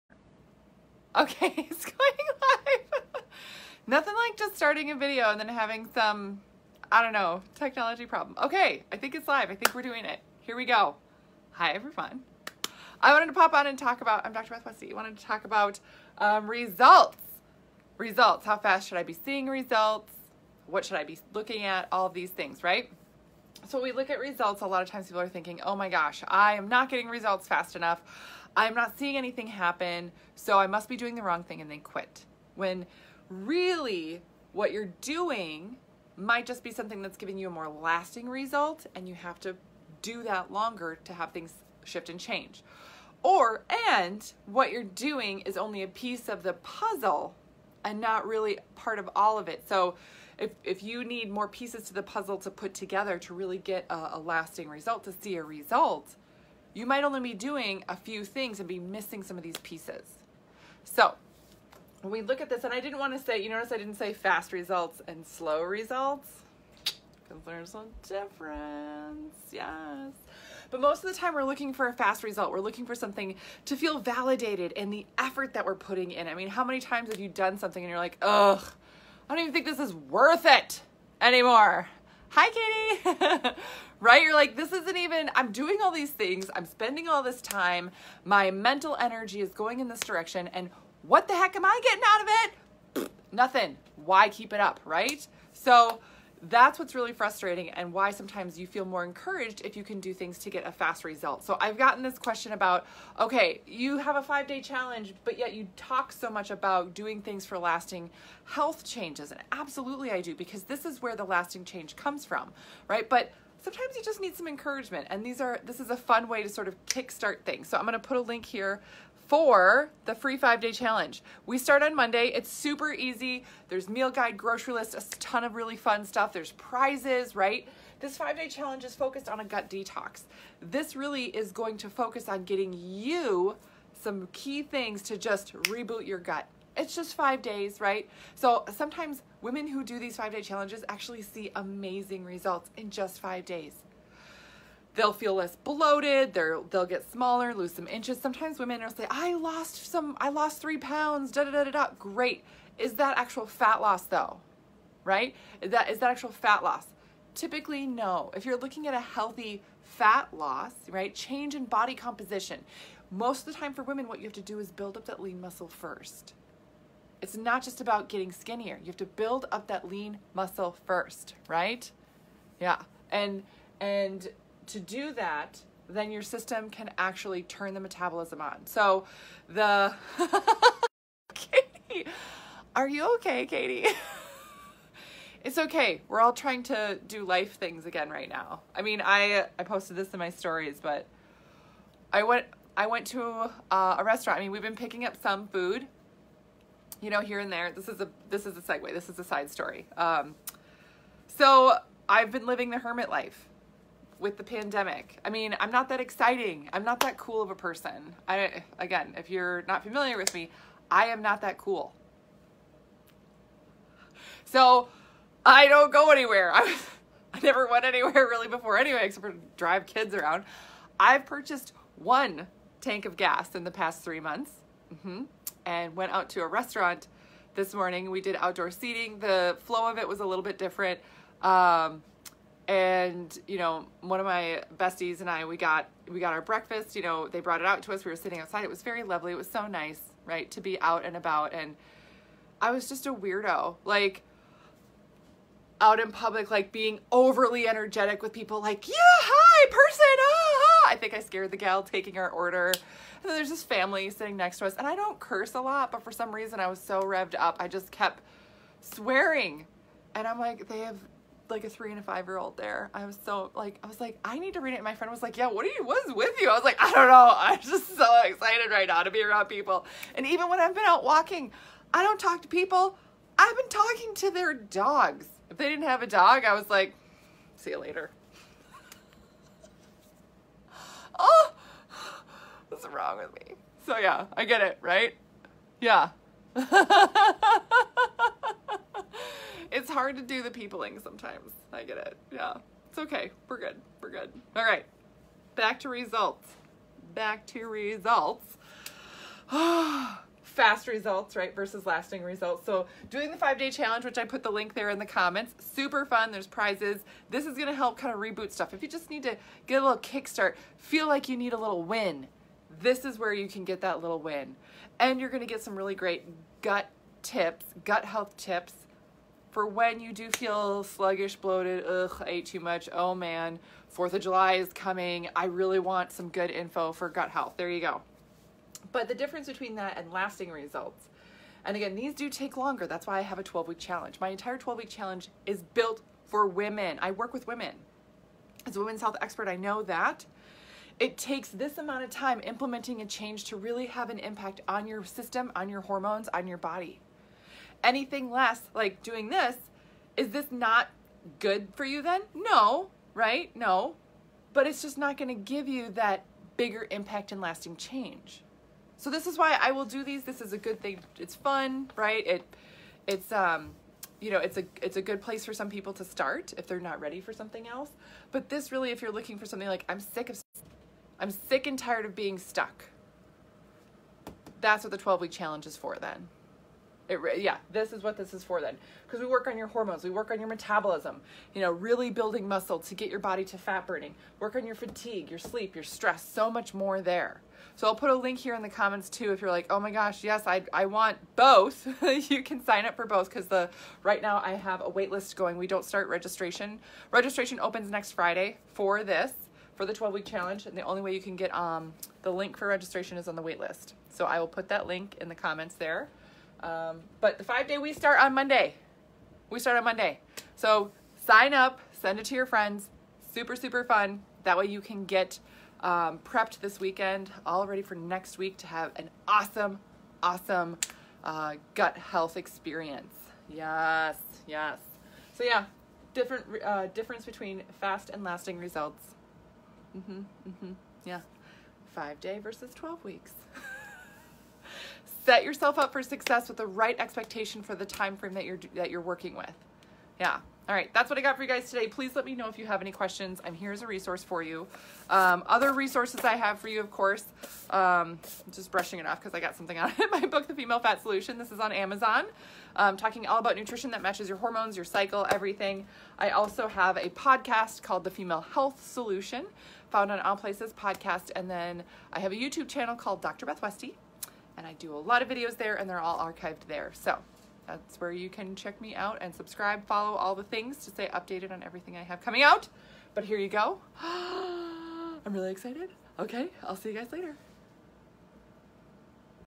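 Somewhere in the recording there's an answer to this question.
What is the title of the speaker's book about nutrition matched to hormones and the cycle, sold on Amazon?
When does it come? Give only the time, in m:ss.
7:30.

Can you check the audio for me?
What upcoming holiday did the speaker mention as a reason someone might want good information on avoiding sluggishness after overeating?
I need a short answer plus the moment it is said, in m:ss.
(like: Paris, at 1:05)
4th of July, at 5:23.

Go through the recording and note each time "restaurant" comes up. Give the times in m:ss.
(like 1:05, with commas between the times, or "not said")
3:14, 3:46.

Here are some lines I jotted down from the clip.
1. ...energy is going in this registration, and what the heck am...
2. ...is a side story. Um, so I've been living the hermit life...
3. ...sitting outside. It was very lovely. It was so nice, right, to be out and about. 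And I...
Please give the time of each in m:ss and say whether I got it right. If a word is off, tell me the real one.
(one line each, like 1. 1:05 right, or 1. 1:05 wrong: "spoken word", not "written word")
1. 1:28 wrong: "direction", not "registration"
2. 3:19 right
3. 3:58 right.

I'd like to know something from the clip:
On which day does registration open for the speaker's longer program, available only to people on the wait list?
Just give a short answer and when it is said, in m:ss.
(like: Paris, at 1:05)
Friday, at 6:37.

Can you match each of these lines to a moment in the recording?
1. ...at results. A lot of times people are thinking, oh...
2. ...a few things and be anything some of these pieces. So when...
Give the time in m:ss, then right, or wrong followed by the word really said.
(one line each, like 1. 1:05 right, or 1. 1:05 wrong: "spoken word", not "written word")
1. 0:24 right
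2. 0:57 wrong: "missing", not "anything".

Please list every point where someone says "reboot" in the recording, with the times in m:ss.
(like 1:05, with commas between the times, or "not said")
2:15, 5:08.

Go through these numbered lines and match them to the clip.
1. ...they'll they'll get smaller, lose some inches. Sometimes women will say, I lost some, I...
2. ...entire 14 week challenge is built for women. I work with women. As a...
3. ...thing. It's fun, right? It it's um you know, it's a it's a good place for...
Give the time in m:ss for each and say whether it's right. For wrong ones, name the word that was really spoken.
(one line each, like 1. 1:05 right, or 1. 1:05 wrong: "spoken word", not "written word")
1. 2:26 right
2. 5:34 wrong: "12", not "14"
3. 6:00 right.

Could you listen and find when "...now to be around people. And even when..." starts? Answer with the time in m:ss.
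4:28.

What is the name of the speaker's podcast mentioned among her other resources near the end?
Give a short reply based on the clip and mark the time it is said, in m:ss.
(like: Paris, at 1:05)
The Female Health Solution, at 7:38.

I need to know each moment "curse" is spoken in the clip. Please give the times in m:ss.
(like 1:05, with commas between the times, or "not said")
4:15.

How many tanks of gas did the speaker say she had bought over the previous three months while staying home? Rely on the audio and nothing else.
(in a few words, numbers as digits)
1.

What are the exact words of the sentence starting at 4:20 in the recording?
And I'm like, they have like a three and a five year old there.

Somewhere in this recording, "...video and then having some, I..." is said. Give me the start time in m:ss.
0:04.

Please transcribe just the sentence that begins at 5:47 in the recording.
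Anything less, like doing this, is this not good for you then?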